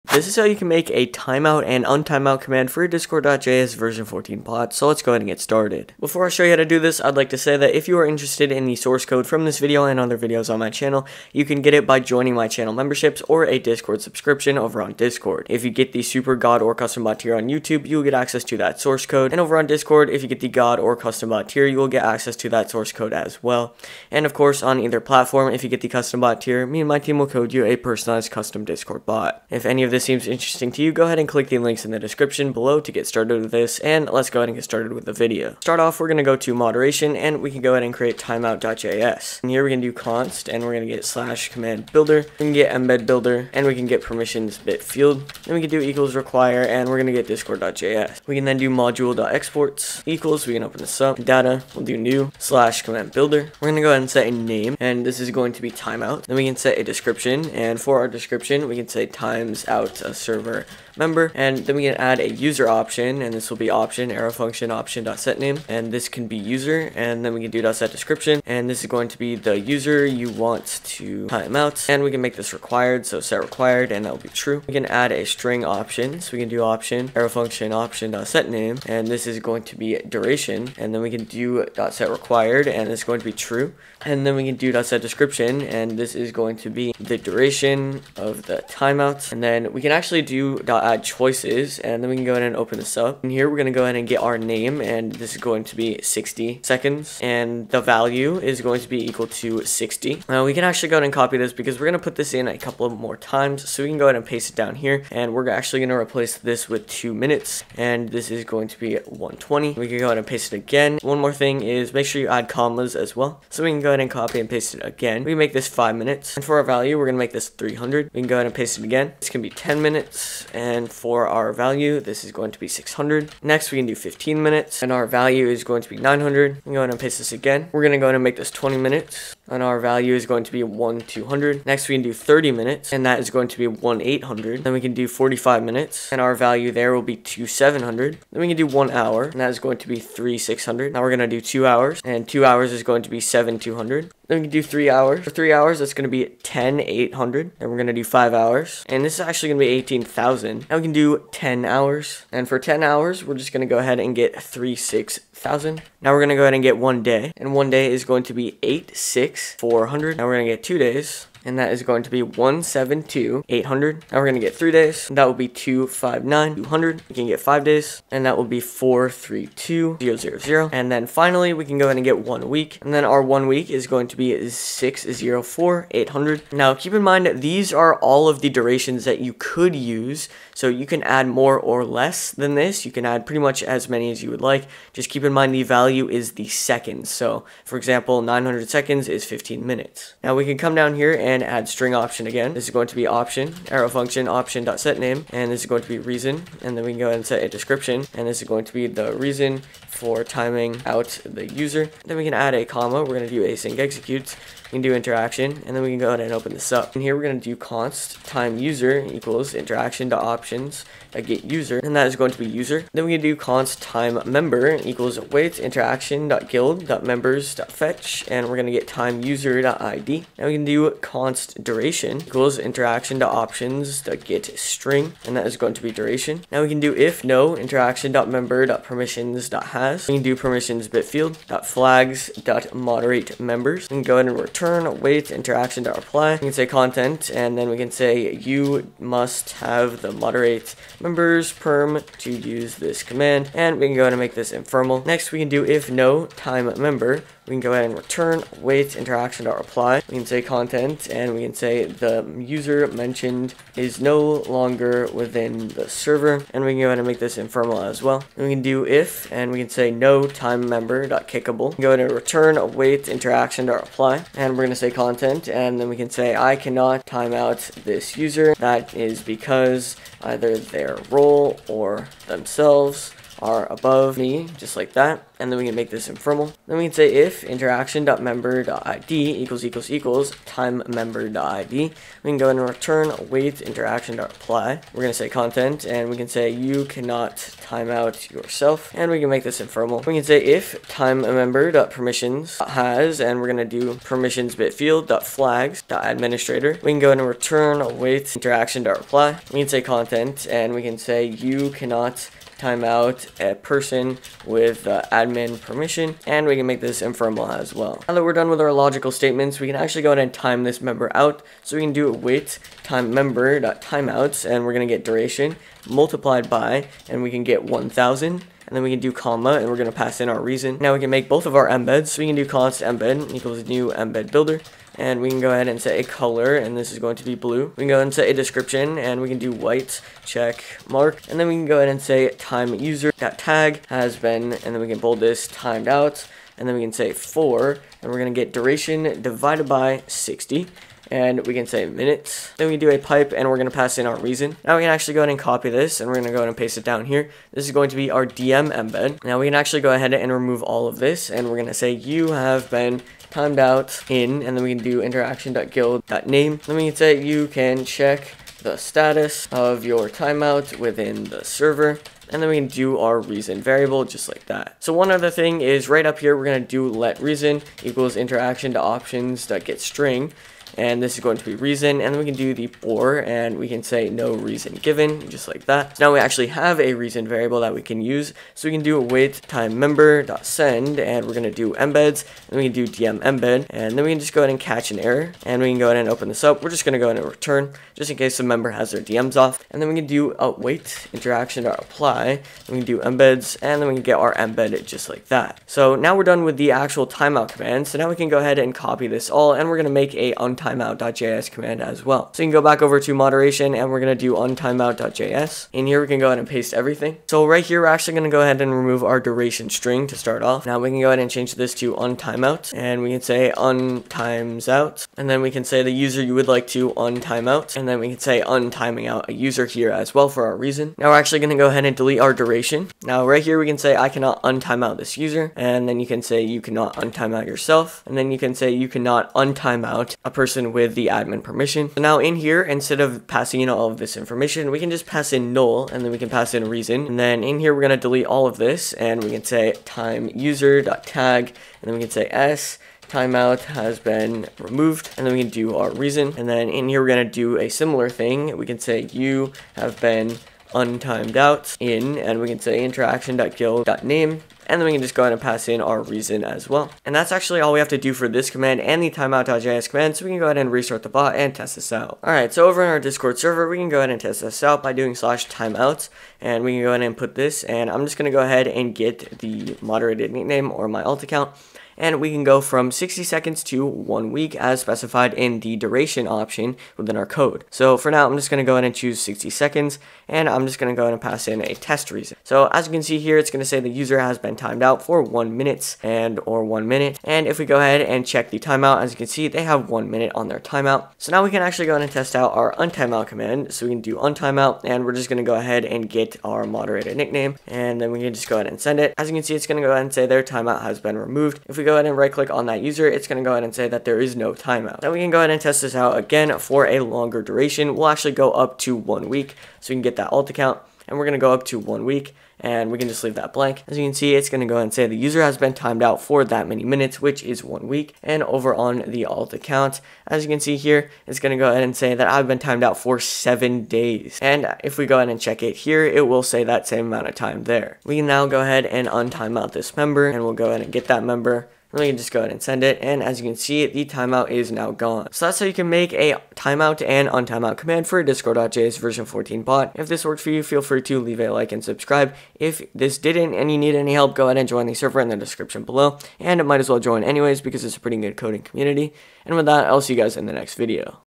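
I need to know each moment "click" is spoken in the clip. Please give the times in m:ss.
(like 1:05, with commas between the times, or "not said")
0:31, 8:22.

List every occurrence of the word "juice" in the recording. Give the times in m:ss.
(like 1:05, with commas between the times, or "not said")
not said.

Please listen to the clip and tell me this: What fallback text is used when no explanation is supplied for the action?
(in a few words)
No reason given.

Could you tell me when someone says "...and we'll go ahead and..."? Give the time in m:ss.
8:50.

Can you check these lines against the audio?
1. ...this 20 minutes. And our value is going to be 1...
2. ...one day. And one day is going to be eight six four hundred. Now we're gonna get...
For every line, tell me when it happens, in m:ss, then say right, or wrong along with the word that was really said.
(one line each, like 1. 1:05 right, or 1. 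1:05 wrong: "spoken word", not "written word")
1. 2:08 right
2. 2:36 right.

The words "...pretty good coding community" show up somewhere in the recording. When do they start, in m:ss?
9:08.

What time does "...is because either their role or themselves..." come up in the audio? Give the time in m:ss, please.
4:28.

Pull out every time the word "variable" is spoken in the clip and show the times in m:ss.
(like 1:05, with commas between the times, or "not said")
6:03, 6:17.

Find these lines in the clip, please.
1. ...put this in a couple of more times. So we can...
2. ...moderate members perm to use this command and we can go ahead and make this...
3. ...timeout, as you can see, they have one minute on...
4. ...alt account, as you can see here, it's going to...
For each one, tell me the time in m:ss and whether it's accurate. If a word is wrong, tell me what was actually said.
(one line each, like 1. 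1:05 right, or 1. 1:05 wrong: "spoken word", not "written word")
1. 1:42 right
2. 4:00 right
3. 8:08 right
4. 8:39 right.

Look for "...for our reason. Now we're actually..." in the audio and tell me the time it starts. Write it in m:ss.
7:00.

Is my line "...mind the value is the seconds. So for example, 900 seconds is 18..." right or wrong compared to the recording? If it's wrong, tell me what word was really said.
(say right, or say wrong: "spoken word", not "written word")
wrong: "15", not "18".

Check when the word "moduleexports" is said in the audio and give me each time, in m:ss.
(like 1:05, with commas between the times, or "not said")
0:48.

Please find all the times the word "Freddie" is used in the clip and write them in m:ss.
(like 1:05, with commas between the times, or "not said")
not said.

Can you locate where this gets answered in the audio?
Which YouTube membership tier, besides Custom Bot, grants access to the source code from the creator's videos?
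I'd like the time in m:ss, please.
0:16.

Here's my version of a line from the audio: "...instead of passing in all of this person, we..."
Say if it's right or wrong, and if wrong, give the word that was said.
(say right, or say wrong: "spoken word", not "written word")
wrong: "information", not "person".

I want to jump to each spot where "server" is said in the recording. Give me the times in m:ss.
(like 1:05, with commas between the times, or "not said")
1:00, 4:15, 6:01, 7:43, 9:04.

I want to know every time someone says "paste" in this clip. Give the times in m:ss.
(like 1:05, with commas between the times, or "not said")
1:44, 1:50, 1:54, 1:58, 2:06, 5:46, 6:46.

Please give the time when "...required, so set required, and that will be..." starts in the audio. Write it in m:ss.
1:12.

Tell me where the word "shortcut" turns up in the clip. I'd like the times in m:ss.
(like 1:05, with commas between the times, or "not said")
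not said.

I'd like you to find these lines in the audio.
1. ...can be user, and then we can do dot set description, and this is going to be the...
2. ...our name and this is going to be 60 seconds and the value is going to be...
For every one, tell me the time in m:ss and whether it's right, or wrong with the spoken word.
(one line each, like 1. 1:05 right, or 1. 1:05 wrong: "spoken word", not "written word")
1. 1:06 right
2. 1:34 right.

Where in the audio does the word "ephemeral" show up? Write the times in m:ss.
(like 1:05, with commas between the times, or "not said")
4:04, 4:17, 4:36, 4:49, 5:07.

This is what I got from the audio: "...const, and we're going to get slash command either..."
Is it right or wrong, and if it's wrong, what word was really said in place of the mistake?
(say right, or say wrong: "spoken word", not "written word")
wrong: "builder", not "either".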